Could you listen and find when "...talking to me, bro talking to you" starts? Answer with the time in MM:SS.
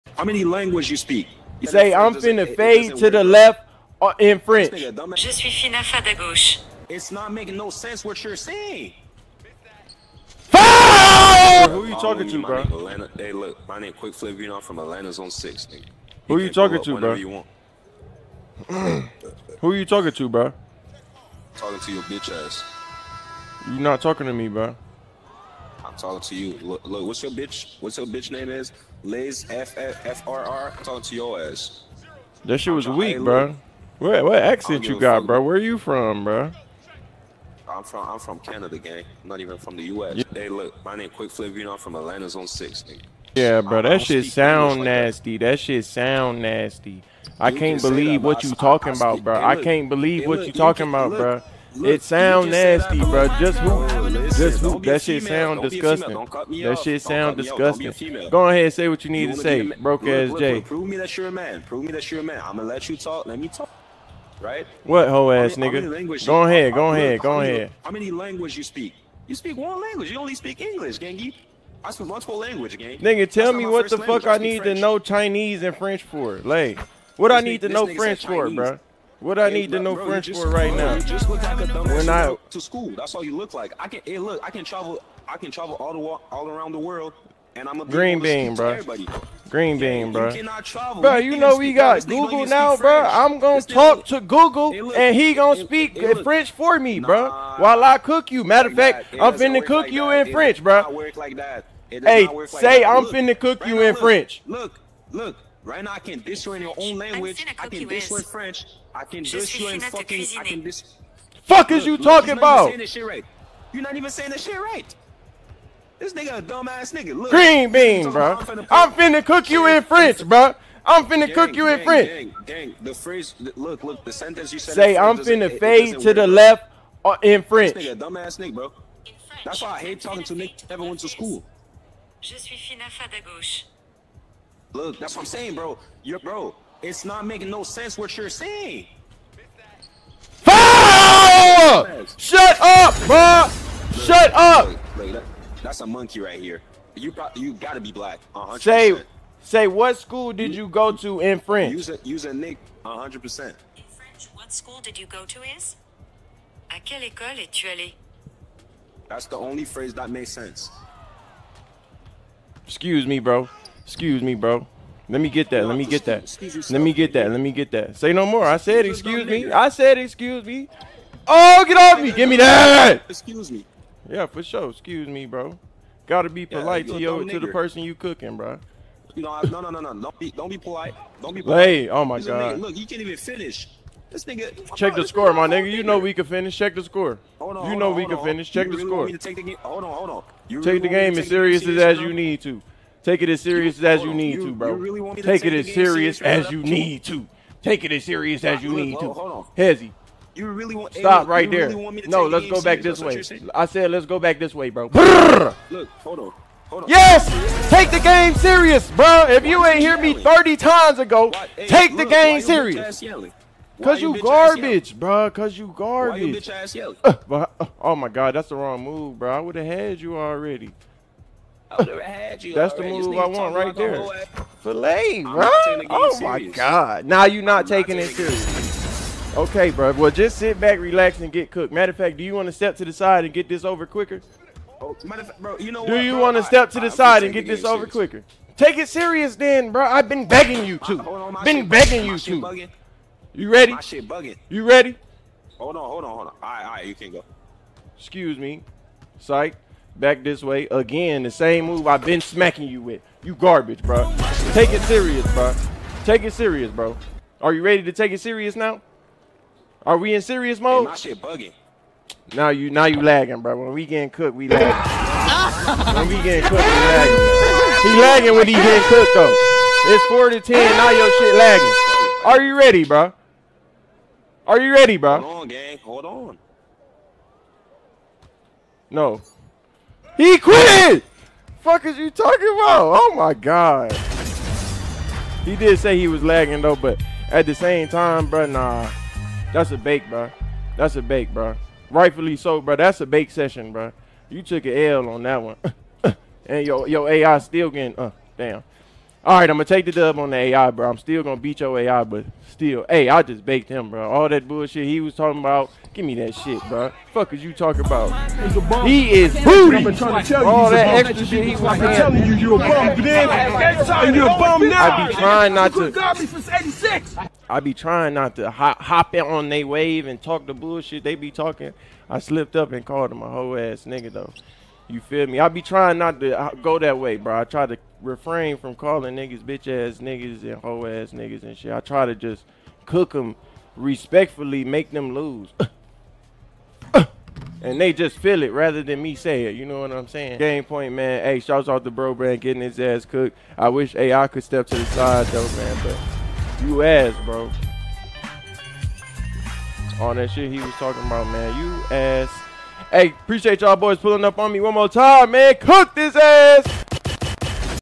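00:24.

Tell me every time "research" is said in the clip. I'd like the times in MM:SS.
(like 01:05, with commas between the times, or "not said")
not said.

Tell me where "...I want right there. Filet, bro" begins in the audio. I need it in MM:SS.
03:43.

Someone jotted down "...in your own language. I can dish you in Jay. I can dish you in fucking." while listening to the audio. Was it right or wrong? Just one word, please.
wrong.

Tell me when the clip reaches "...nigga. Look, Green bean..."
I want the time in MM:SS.
01:56.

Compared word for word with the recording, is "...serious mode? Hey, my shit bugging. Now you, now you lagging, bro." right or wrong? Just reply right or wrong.
right.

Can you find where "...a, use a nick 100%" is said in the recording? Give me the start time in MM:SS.
02:31.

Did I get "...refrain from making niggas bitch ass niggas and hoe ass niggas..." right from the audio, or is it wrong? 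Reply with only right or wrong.
wrong.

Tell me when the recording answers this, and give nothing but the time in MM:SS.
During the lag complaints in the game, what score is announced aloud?
04:30.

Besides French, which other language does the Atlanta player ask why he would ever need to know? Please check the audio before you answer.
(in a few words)
Chinese.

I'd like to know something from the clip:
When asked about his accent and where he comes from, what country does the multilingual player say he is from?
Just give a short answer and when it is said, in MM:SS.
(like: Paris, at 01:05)
Canada, at 00:38.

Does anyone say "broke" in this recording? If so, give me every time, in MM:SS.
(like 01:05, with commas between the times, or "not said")
00:59.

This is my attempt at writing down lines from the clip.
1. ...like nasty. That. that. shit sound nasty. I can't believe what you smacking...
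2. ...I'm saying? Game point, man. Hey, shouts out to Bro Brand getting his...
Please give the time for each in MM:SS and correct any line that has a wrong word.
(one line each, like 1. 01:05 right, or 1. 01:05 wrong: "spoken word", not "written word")
1. 00:44 wrong: "talking", not "smacking"
2. 05:39 right.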